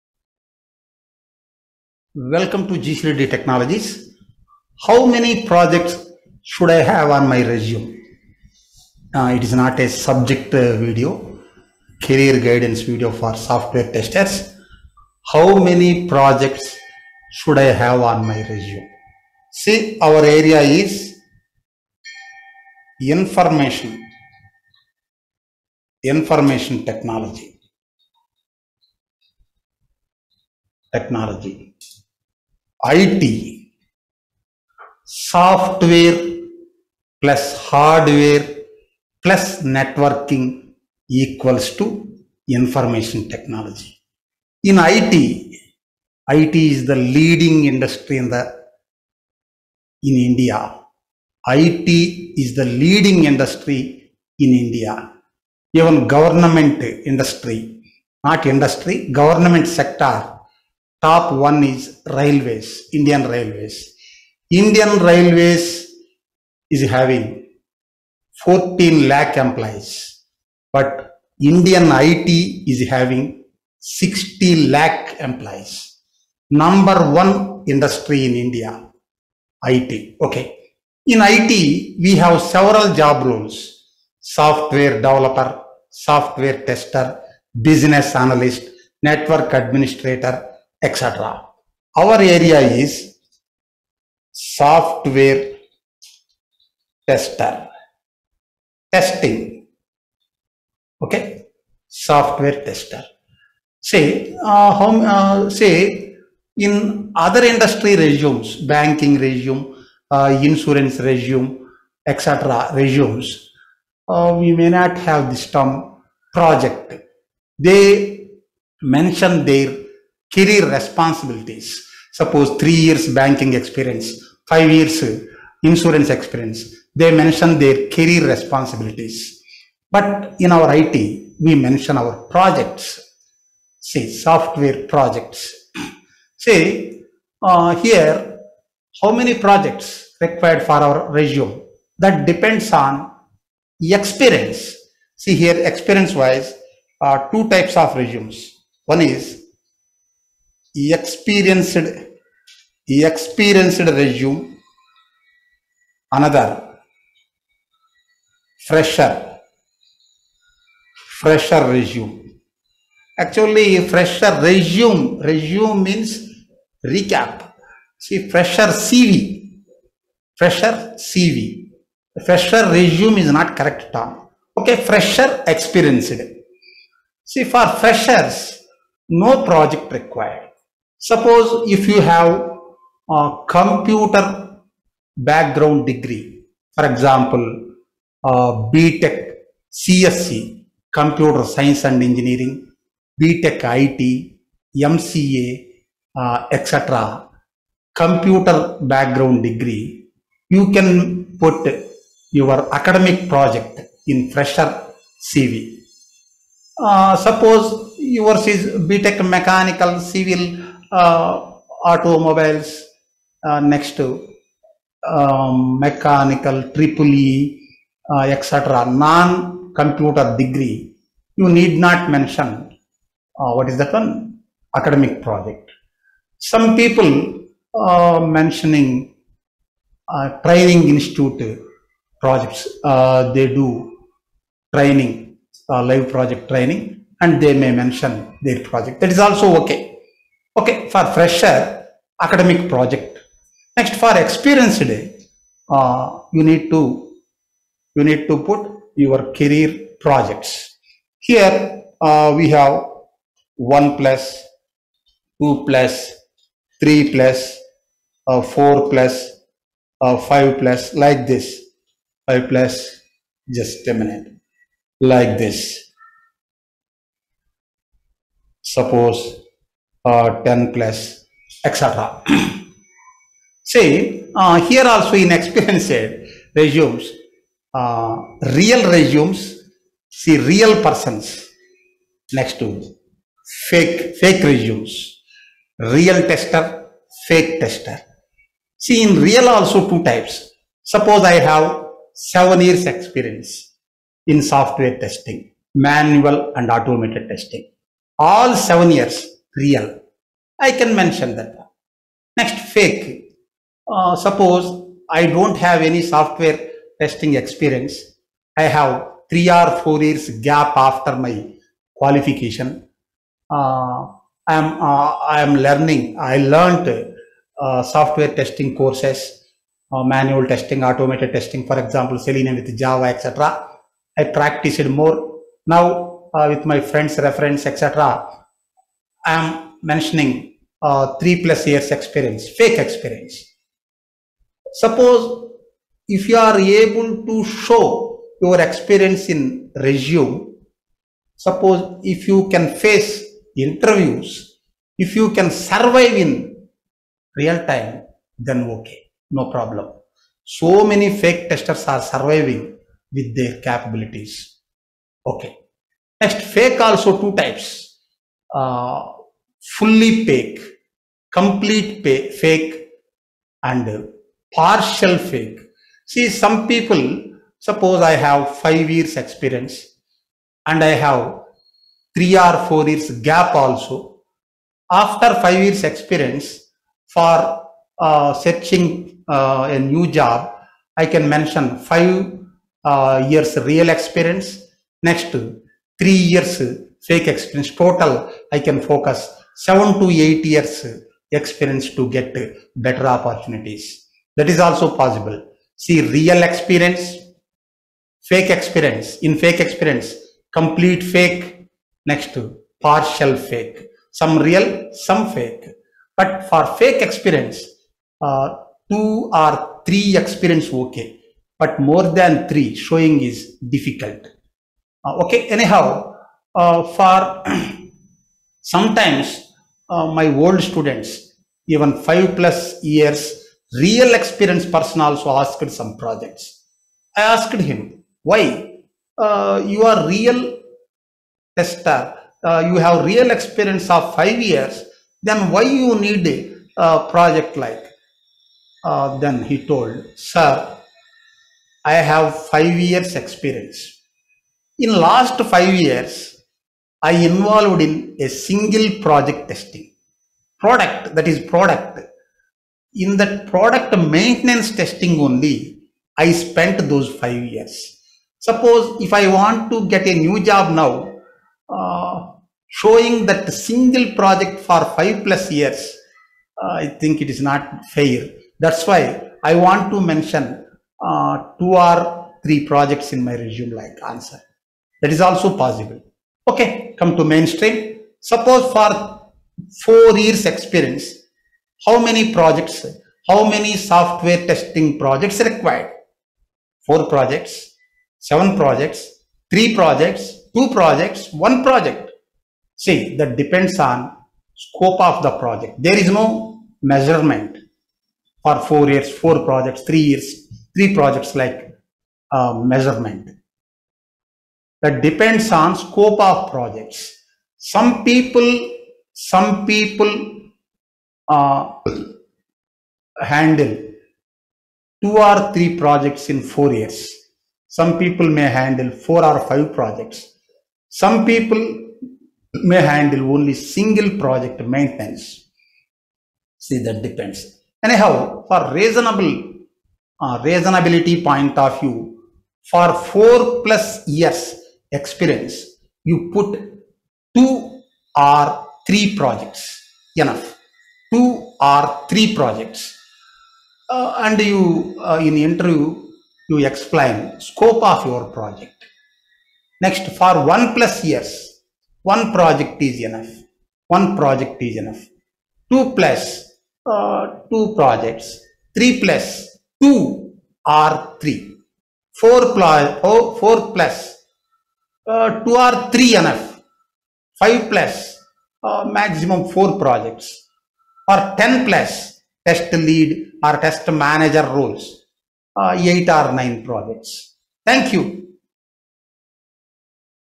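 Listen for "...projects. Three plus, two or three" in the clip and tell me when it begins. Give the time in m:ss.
9:17.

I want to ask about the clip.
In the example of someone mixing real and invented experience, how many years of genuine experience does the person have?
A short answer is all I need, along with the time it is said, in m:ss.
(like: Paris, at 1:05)
5, at 6:21.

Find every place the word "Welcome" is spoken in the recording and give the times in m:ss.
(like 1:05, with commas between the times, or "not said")
0:02.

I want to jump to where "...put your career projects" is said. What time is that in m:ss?
4:08.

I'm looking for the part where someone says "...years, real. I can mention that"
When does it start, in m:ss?
4:58.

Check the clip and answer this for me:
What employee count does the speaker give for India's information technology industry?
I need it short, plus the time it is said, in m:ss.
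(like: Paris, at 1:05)
60 lakh, at 1:13.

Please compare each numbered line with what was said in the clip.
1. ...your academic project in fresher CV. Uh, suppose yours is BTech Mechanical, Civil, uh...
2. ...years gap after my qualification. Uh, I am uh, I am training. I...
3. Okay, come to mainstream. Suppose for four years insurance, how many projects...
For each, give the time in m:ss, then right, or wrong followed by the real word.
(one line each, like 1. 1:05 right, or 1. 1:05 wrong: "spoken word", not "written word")
1. 3:22 right
2. 5:10 wrong: "learning", not "training"
3. 7:56 wrong: "experience", not "insurance".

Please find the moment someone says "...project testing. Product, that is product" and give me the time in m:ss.
7:29.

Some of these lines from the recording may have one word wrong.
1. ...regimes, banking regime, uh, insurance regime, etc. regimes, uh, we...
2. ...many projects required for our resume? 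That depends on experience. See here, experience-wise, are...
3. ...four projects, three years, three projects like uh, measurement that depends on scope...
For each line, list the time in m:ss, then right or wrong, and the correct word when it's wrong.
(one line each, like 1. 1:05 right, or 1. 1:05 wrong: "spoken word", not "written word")
1. 1:47 right
2. 2:19 right
3. 8:19 right.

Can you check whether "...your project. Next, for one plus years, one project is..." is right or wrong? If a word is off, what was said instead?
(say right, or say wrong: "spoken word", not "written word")
right.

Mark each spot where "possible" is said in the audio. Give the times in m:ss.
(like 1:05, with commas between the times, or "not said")
6:35, 7:55.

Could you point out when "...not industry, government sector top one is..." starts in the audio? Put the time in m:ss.
0:58.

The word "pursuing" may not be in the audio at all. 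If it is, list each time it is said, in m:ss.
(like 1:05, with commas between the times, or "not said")
not said.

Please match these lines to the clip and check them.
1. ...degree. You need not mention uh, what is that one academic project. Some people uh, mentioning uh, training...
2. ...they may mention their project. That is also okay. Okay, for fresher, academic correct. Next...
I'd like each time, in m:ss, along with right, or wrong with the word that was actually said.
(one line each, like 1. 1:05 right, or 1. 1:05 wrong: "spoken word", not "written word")
1. 3:40 right
2. 3:57 wrong: "project", not "correct".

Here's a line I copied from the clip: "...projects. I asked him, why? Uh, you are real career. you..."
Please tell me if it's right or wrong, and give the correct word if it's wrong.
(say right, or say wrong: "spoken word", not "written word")
wrong: "tester", not "career".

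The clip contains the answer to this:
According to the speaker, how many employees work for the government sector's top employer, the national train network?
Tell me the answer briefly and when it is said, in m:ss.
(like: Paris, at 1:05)
14 lakh, at 1:08.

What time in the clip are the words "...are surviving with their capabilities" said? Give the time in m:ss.
5:51.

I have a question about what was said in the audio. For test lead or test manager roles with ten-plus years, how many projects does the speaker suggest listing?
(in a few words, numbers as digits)
8 or 9.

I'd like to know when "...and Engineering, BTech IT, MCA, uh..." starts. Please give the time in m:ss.
3:11.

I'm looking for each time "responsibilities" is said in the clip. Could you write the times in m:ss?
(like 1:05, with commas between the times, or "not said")
2:00, 2:08.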